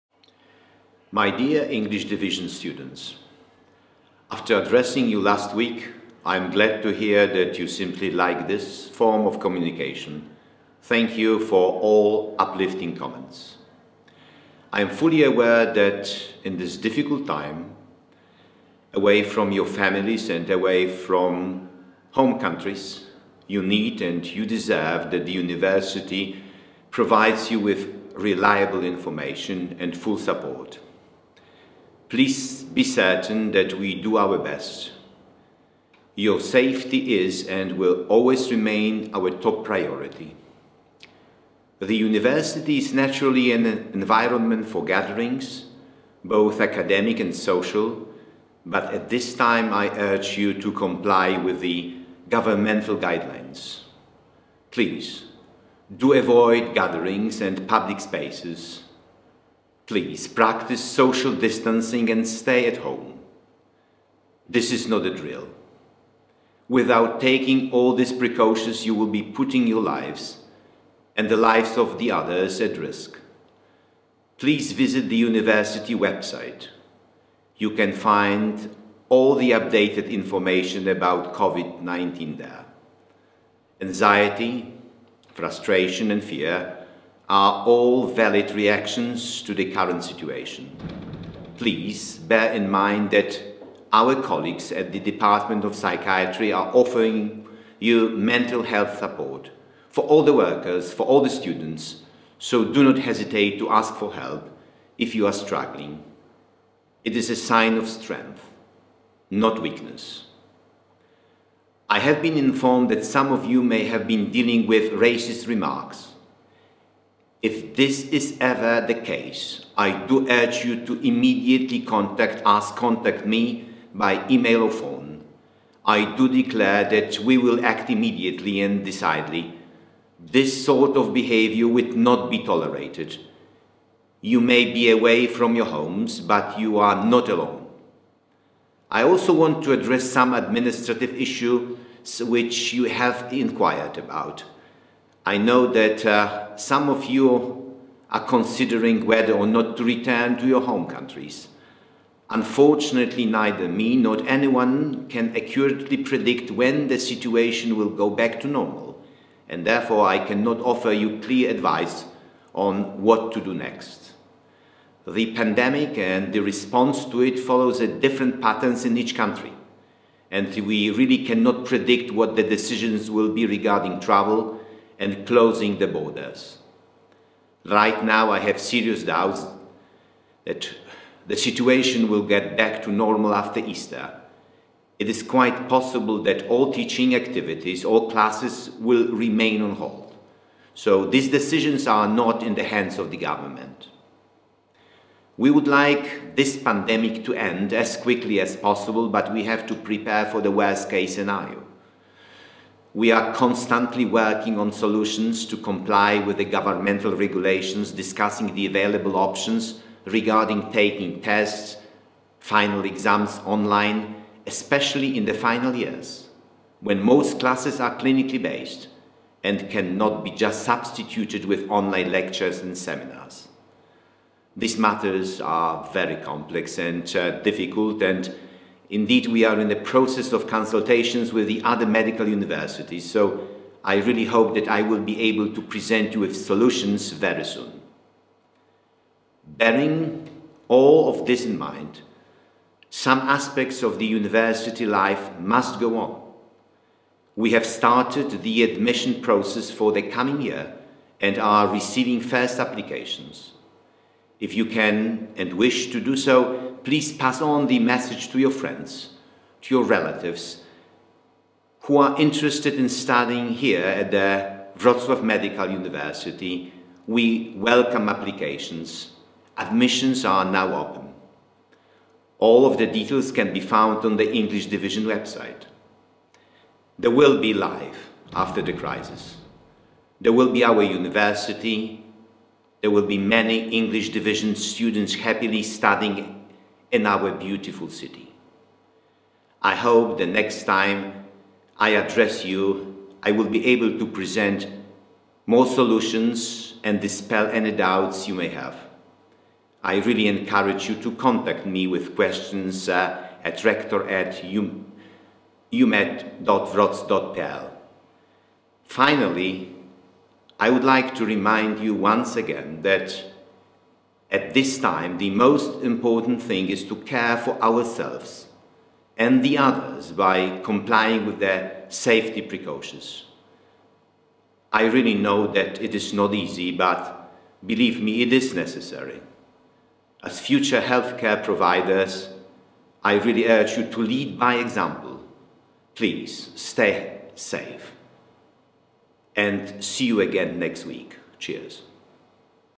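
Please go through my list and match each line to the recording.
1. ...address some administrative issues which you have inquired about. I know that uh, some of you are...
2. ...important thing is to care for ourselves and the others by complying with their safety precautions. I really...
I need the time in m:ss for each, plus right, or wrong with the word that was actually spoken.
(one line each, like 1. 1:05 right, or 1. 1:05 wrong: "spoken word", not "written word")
1. 2:19 right
2. 5:15 right.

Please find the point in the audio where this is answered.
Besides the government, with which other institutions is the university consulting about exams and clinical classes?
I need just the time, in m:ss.
3:51.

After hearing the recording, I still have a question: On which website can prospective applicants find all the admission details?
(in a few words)
English Division website.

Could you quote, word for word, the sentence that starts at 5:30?
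As future healthcare providers, I really urge you to lead by example.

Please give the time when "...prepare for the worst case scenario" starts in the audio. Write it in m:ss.
3:19.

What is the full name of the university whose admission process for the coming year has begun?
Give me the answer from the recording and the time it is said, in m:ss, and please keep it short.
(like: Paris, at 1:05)
Wrocław Medical University, at 4:24.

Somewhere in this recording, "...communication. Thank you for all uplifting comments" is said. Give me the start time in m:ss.
0:09.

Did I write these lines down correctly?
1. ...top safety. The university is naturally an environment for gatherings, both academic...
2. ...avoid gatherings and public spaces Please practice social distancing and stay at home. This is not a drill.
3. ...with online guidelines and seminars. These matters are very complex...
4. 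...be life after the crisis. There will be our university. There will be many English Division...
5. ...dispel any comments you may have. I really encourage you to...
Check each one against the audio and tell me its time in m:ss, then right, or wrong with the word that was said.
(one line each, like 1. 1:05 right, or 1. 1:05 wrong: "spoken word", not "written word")
1. 0:39 wrong: "priority", not "safety"
2. 0:56 right
3. 3:41 wrong: "lectures", not "guidelines"
4. 4:37 right
5. 4:56 wrong: "doubts", not "comments".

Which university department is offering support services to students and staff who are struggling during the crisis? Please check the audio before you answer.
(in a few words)
Department of Psychiatry.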